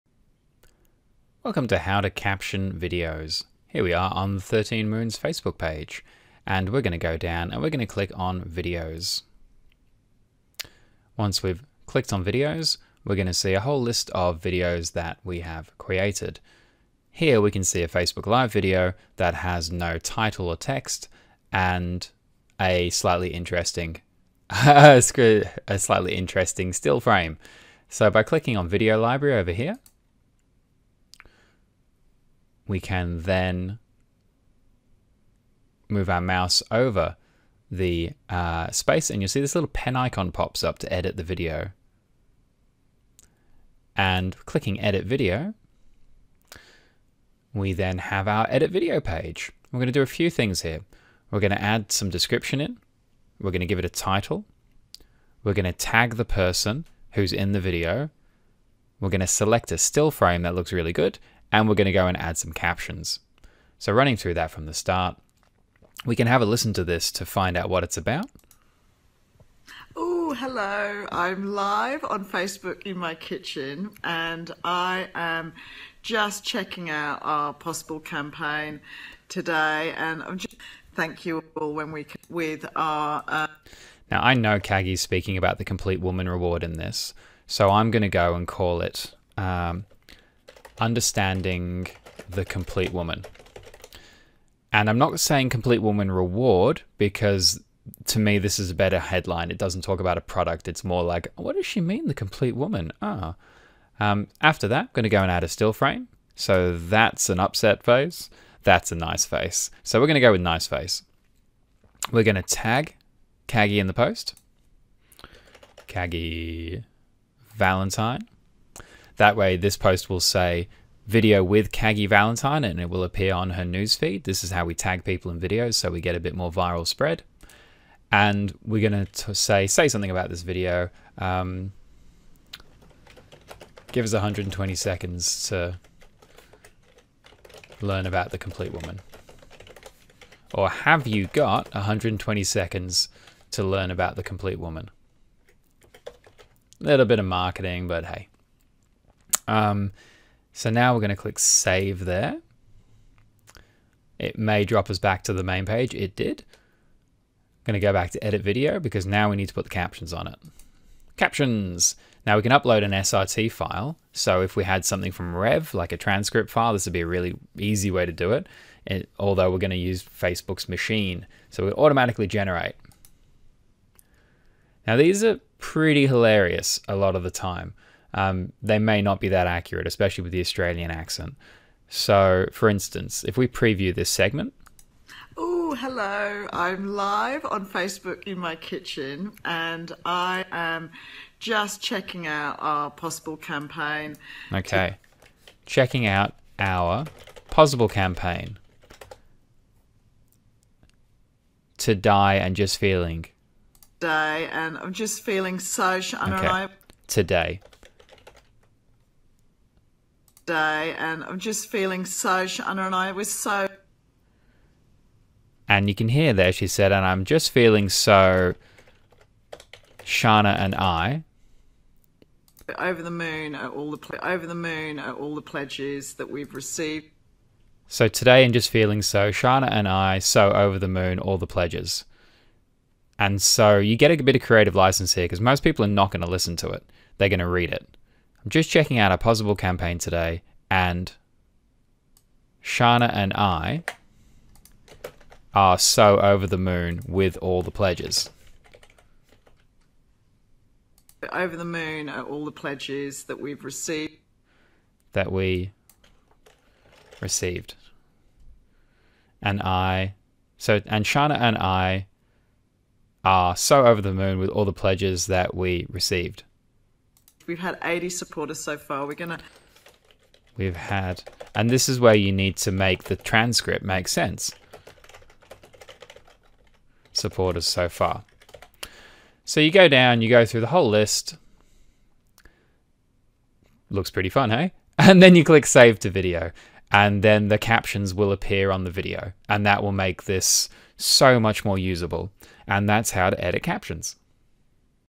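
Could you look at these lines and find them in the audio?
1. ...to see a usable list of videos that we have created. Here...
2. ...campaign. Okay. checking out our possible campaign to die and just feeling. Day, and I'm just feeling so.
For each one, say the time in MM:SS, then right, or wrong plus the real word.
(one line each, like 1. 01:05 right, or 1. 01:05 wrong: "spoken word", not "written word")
1. 00:13 wrong: "whole", not "usable"
2. 03:13 right.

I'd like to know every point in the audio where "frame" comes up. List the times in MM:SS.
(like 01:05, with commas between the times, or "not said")
00:26, 01:00, 01:45.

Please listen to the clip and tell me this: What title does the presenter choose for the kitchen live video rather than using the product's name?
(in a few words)
Understanding the complete woman.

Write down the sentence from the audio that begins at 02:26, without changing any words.
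A little bit of marketing, but hey.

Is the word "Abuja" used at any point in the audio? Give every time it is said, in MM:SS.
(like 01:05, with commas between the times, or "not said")
not said.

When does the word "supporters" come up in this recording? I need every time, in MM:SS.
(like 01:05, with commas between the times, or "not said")
04:28, 04:37.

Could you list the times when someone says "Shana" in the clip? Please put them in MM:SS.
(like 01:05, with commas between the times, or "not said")
03:32, 03:40, 03:49, 04:02, 04:21.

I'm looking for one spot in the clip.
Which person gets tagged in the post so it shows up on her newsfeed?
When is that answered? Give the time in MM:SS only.
01:55.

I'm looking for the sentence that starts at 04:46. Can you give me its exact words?
And then the captions will appear on the video.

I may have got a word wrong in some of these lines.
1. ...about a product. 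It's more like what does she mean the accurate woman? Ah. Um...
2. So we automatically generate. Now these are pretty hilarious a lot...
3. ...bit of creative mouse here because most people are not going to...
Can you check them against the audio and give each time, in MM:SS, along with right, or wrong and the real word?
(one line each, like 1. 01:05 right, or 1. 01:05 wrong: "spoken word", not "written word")
1. 01:39 wrong: "complete", not "accurate"
2. 02:51 right
3. 03:54 wrong: "license", not "mouse".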